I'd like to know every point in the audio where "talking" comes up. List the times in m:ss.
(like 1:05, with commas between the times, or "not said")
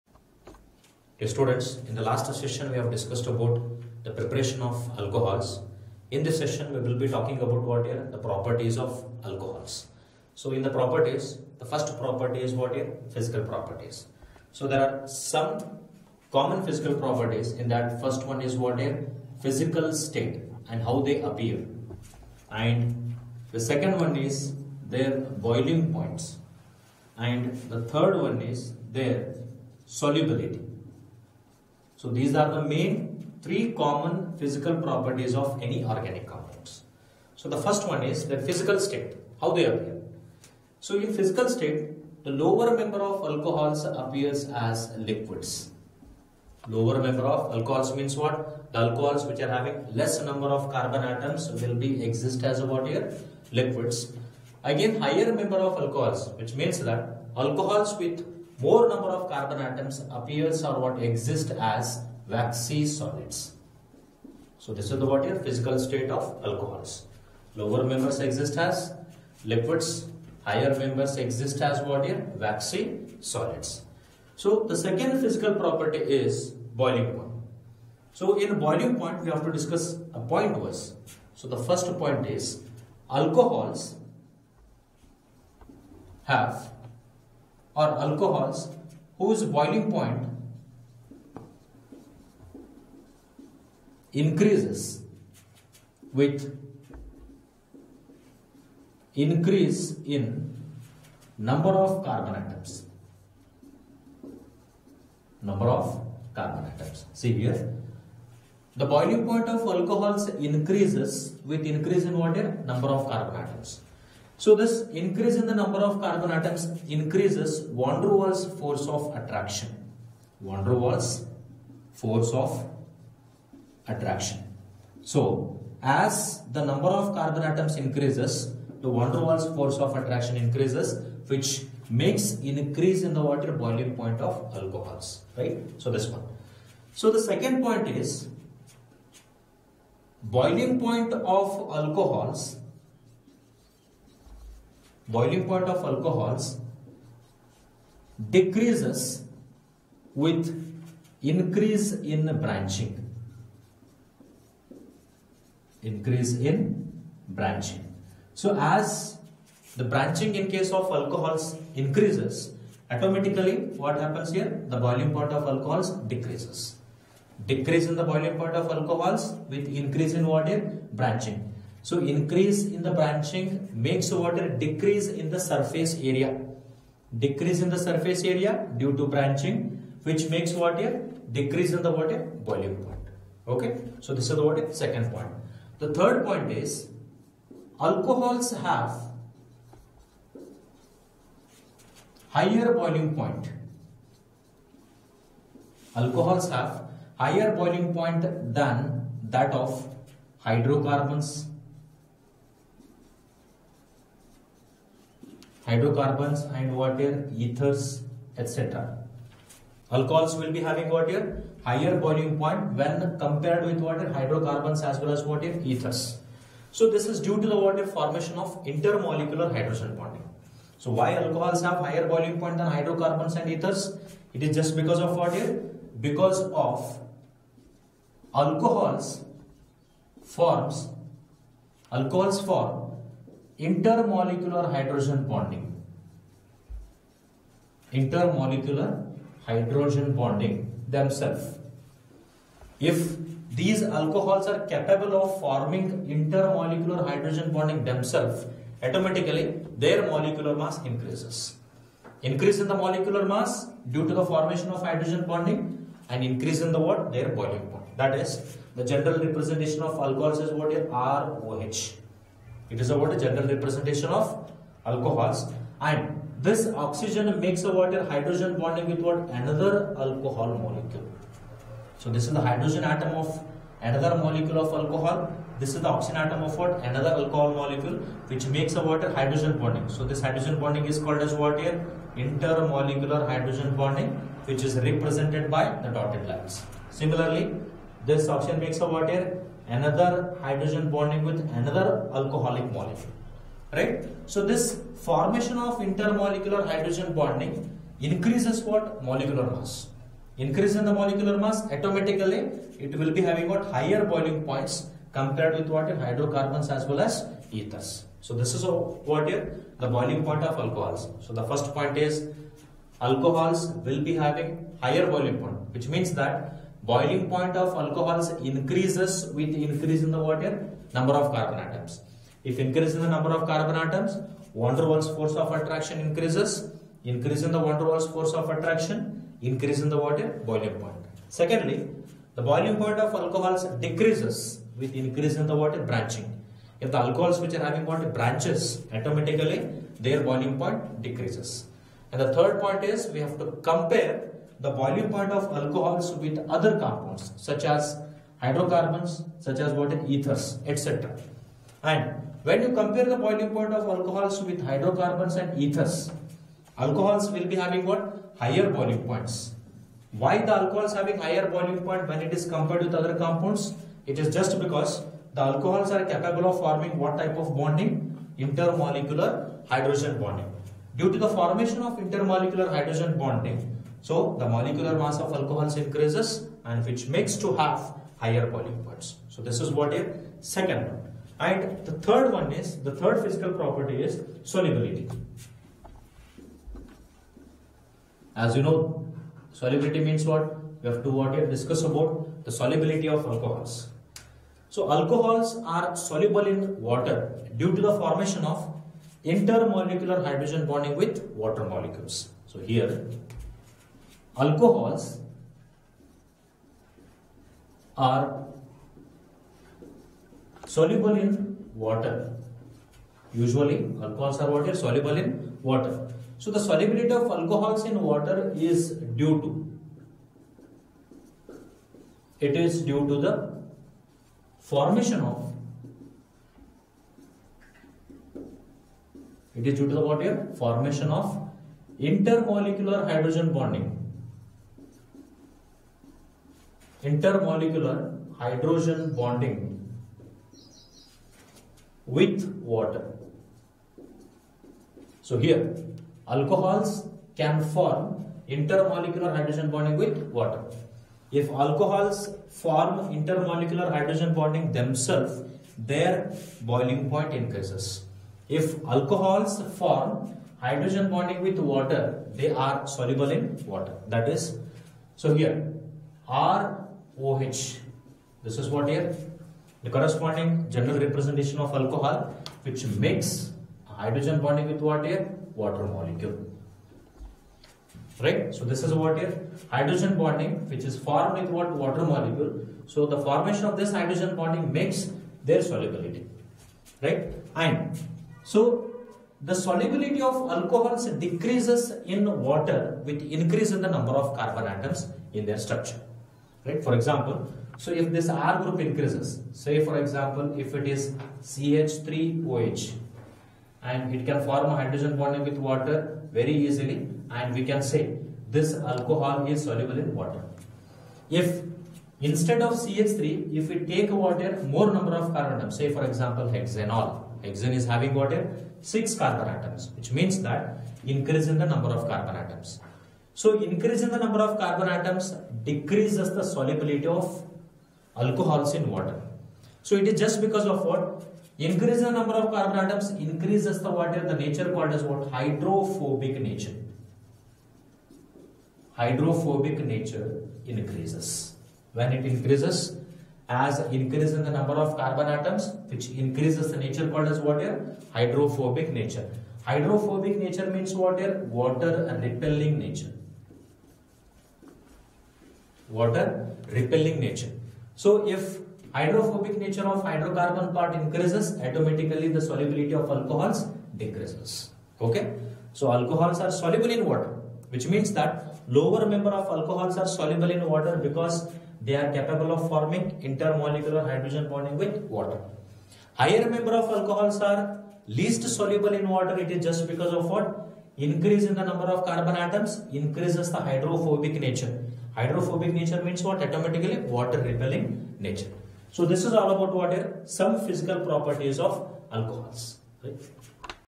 0:07.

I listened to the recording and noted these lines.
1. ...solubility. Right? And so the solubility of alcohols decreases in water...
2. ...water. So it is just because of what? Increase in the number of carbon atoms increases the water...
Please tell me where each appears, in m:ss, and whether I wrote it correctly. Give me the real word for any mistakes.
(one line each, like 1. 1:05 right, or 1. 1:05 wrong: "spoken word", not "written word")
1. 8:05 right
2. 8:48 right.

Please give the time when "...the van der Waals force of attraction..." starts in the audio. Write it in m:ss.
2:08.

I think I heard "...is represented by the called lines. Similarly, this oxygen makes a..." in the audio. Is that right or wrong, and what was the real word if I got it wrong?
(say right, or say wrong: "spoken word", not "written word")
wrong: "dotted", not "called".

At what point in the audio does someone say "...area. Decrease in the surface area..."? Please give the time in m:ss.
2:55.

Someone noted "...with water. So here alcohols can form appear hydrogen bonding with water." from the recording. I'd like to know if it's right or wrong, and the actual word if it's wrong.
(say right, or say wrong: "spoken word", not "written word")
wrong: "intermolecular", not "appear".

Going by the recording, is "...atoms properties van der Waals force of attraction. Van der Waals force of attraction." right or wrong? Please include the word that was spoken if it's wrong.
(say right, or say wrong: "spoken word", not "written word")
wrong: "increases", not "properties".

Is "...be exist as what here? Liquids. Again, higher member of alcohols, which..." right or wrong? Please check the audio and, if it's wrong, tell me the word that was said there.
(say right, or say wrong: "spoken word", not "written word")
right.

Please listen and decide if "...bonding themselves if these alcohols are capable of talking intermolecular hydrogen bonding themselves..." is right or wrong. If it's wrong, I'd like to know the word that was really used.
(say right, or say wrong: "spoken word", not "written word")
wrong: "forming", not "talking".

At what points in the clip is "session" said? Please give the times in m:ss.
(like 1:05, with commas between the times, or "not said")
0:02, 0:06.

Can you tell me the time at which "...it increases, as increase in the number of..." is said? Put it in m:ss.
9:02.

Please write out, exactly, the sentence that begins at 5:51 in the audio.
And when you compare the boiling point of alcohols with hydrocarbons and ethers, alcohols will be having what?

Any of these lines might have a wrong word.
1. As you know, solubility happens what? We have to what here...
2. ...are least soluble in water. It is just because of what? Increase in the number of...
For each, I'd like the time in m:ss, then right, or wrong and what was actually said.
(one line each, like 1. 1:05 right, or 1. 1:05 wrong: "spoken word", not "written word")
1. 6:28 wrong: "means", not "happens"
2. 9:37 right.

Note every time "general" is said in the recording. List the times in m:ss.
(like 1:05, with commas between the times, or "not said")
4:18, 4:23, 7:50.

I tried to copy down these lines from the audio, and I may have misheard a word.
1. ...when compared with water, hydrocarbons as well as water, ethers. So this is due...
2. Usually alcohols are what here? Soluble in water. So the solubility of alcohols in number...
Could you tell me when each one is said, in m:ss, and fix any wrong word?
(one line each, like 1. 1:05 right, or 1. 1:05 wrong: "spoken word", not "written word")
1. 3:32 right
2. 6:53 wrong: "water", not "number".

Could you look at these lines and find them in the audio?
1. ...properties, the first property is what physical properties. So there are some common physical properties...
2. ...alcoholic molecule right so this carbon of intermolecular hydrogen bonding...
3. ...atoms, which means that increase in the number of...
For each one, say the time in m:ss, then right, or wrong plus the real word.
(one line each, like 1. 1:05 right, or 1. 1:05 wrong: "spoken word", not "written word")
1. 0:10 right
2. 4:52 wrong: "formation", not "carbon"
3. 8:39 right.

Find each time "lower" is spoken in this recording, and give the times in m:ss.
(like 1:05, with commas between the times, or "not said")
0:42, 0:46, 1:07, 9:28.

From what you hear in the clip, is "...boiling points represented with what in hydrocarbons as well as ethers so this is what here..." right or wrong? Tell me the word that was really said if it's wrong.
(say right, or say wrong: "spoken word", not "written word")
wrong: "compared", not "represented".